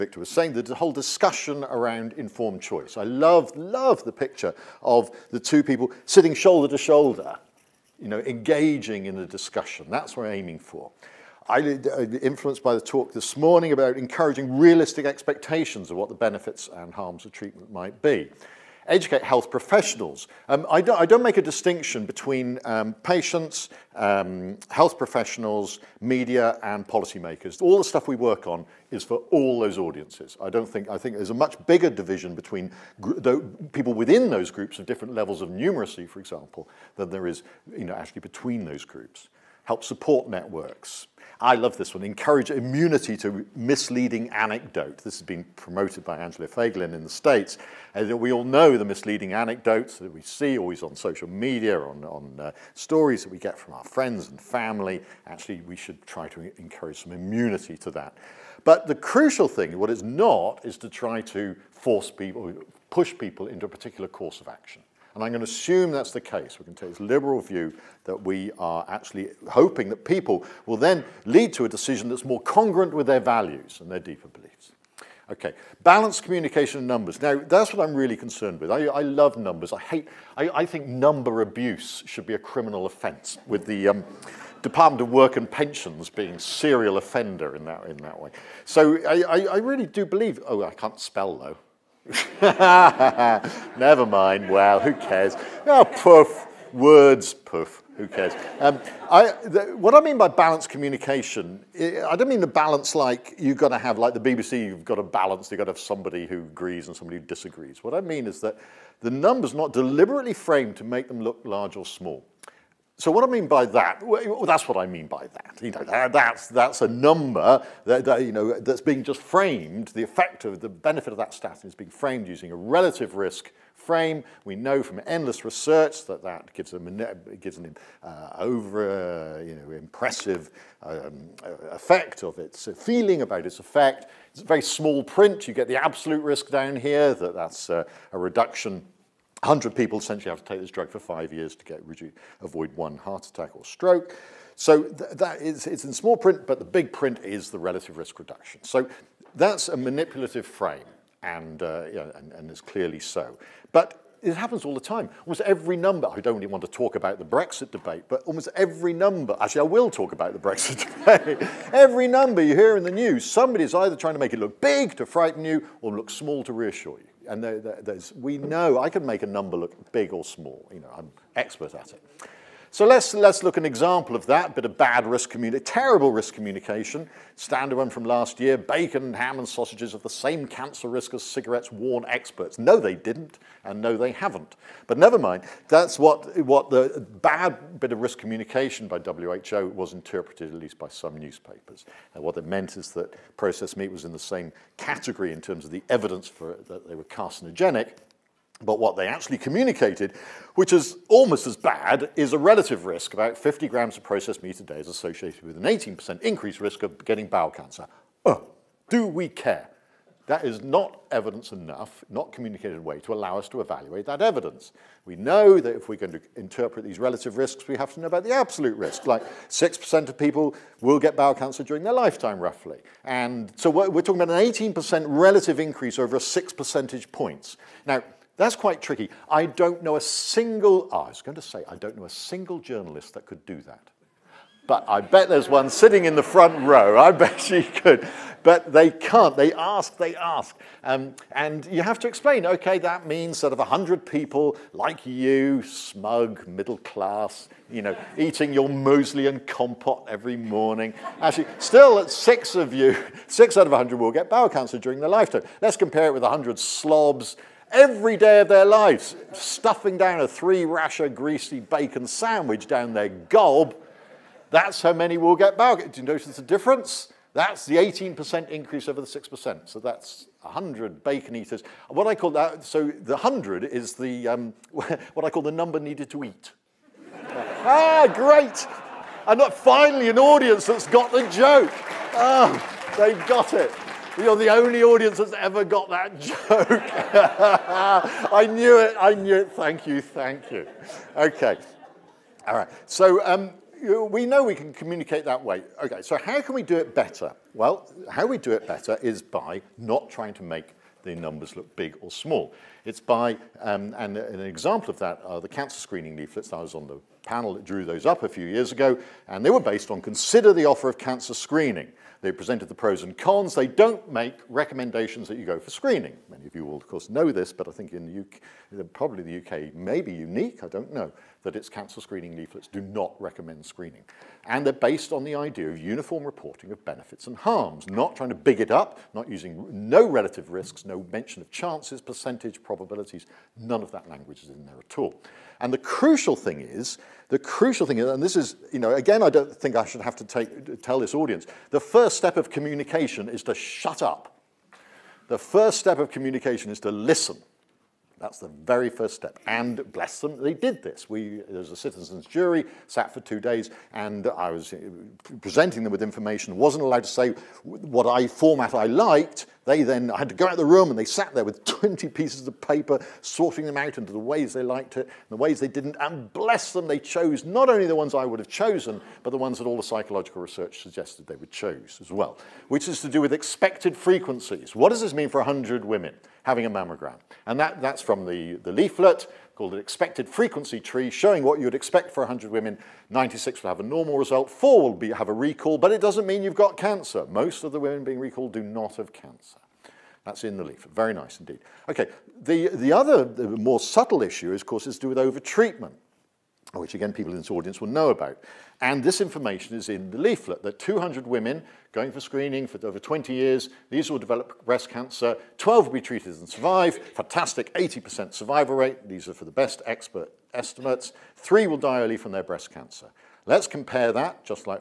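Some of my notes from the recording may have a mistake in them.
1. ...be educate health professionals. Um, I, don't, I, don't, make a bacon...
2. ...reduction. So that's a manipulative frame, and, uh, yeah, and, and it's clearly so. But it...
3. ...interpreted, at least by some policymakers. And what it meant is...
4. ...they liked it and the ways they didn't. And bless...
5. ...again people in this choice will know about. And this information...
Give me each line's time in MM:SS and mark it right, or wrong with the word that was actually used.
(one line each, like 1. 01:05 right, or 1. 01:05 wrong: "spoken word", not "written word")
1. 00:18 wrong: "distinction", not "bacon"
2. 02:28 right
3. 03:09 wrong: "newspapers", not "policymakers"
4. 06:04 right
5. 06:36 wrong: "audience", not "choice".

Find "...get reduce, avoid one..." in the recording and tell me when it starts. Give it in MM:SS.
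02:21.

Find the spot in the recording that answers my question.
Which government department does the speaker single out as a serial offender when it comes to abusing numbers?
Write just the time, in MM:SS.
01:24.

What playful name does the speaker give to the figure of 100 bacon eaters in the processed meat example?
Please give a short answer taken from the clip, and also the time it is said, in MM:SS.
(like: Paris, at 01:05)
number needed to eat, at 04:35.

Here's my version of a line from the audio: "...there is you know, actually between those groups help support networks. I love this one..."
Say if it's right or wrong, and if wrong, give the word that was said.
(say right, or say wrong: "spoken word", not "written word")
right.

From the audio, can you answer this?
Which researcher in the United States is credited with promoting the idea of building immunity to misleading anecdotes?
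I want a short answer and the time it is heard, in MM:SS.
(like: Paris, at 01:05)
Angela Fagerlin, at 00:46.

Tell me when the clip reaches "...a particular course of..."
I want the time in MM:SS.
01:03.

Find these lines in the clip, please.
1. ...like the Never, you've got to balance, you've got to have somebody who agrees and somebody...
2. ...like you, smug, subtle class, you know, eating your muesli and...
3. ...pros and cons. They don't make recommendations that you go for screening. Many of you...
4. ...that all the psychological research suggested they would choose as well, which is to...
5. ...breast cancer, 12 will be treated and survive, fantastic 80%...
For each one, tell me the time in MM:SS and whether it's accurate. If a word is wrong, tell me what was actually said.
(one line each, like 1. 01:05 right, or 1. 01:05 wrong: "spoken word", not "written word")
1. 01:43 wrong: "BBC", not "Never"
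2. 04:04 wrong: "middle", not "subtle"
3. 05:12 right
4. 06:09 right
5. 06:44 right.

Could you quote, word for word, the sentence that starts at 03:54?
But I bet there's one sitting in the front row.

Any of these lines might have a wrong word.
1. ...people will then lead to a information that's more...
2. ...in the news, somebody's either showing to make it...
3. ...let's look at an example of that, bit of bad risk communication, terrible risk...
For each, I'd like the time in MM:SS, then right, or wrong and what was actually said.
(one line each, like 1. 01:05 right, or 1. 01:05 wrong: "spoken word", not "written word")
1. 01:10 wrong: "decision", not "information"
2. 02:42 wrong: "trying", not "showing"
3. 02:53 right.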